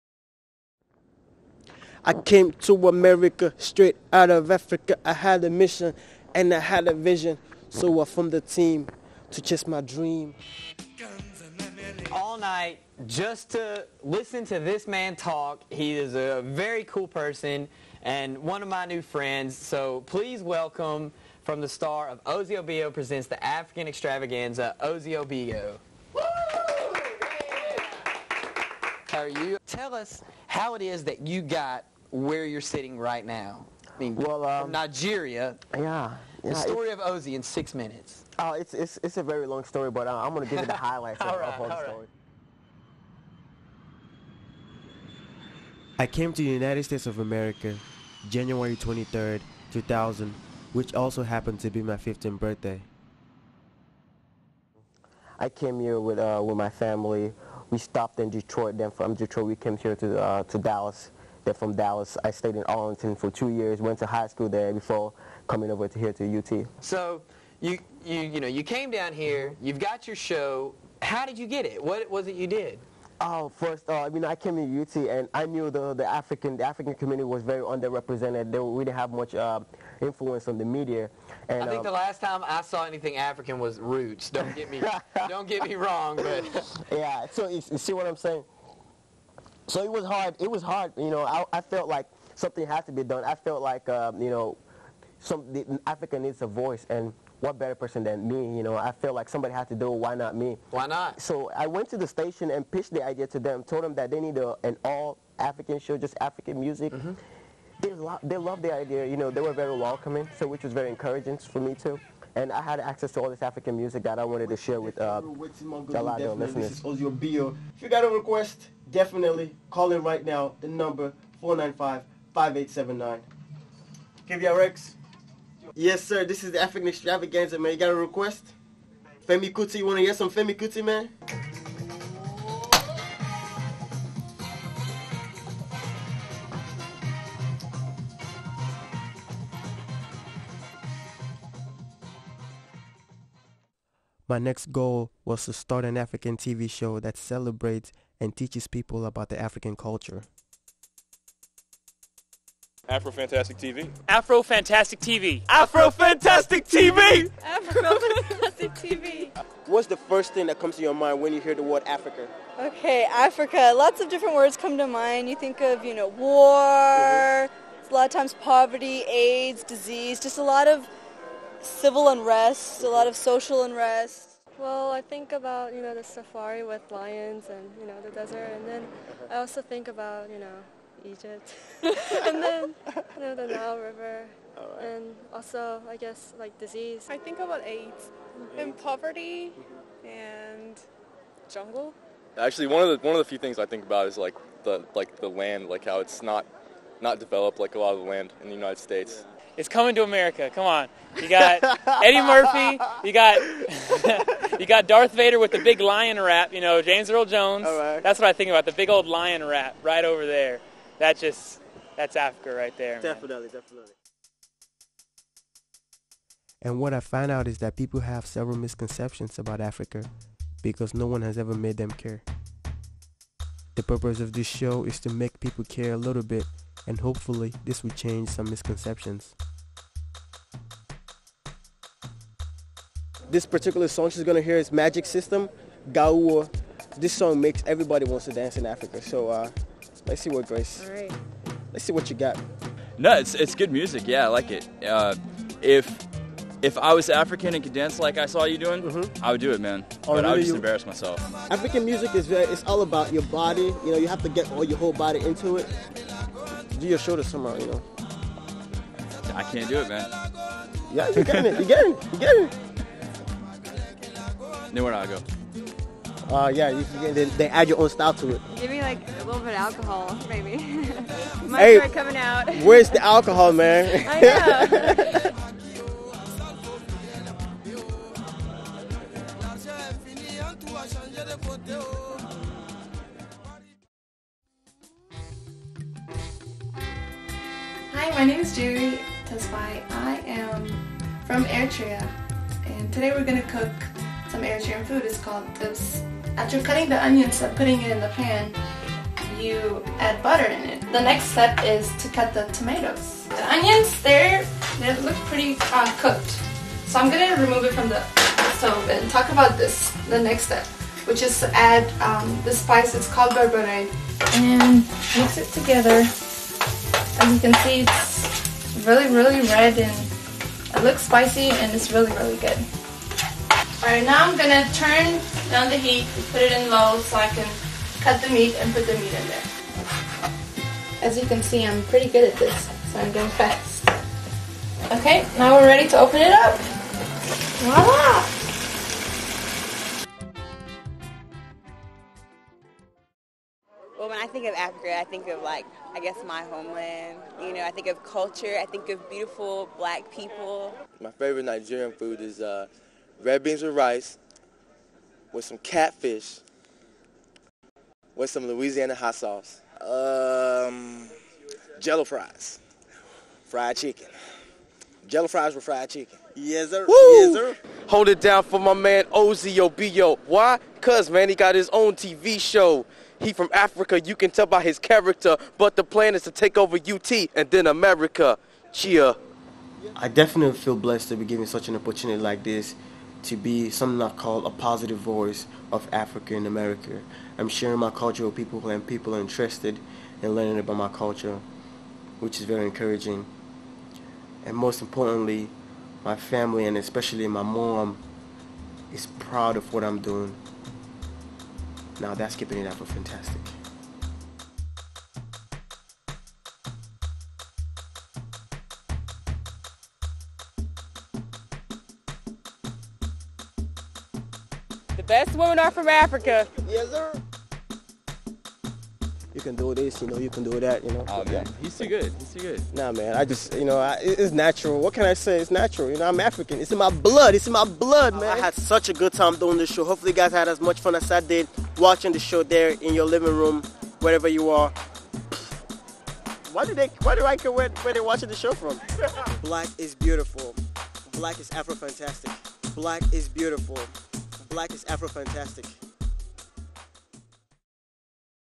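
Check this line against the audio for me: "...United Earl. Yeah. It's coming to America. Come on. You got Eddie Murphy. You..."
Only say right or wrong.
wrong.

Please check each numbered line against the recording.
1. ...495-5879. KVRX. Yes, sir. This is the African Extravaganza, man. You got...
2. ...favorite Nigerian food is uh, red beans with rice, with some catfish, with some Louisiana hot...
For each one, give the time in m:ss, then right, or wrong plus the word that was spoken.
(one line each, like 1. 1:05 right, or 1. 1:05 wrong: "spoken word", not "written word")
1. 2:01 right
2. 5:51 right.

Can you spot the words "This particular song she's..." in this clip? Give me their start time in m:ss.
3:53.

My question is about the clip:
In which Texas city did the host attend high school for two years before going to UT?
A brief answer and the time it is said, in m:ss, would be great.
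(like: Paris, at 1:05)
Arlington, at 1:02.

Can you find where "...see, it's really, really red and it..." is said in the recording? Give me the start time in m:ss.
5:17.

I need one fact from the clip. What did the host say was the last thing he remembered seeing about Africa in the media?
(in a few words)
Roots.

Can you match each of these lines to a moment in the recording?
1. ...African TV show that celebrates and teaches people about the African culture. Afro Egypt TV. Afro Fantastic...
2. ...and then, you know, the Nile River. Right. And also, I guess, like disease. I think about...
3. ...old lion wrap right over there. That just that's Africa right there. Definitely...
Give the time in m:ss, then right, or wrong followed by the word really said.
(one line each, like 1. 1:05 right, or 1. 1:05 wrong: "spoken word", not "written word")
1. 2:25 wrong: "Fantastic", not "Egypt"
2. 3:01 right
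3. 3:28 right.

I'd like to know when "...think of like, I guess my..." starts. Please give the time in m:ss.
5:45.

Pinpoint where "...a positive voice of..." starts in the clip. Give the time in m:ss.
6:24.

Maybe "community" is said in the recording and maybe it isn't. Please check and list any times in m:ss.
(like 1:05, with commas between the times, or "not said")
1:16.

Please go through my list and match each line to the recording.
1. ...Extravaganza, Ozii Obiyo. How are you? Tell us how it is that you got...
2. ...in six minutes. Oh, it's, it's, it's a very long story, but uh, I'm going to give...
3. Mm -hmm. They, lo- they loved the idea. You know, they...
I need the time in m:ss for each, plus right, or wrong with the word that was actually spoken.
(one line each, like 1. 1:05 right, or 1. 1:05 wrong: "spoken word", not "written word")
1. 0:23 right
2. 0:37 right
3. 1:46 right.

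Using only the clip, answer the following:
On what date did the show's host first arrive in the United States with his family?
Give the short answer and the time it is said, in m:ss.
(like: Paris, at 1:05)
January 23, 2000, at 0:48.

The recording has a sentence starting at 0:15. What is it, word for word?
He is a very cool person and one of my new friends.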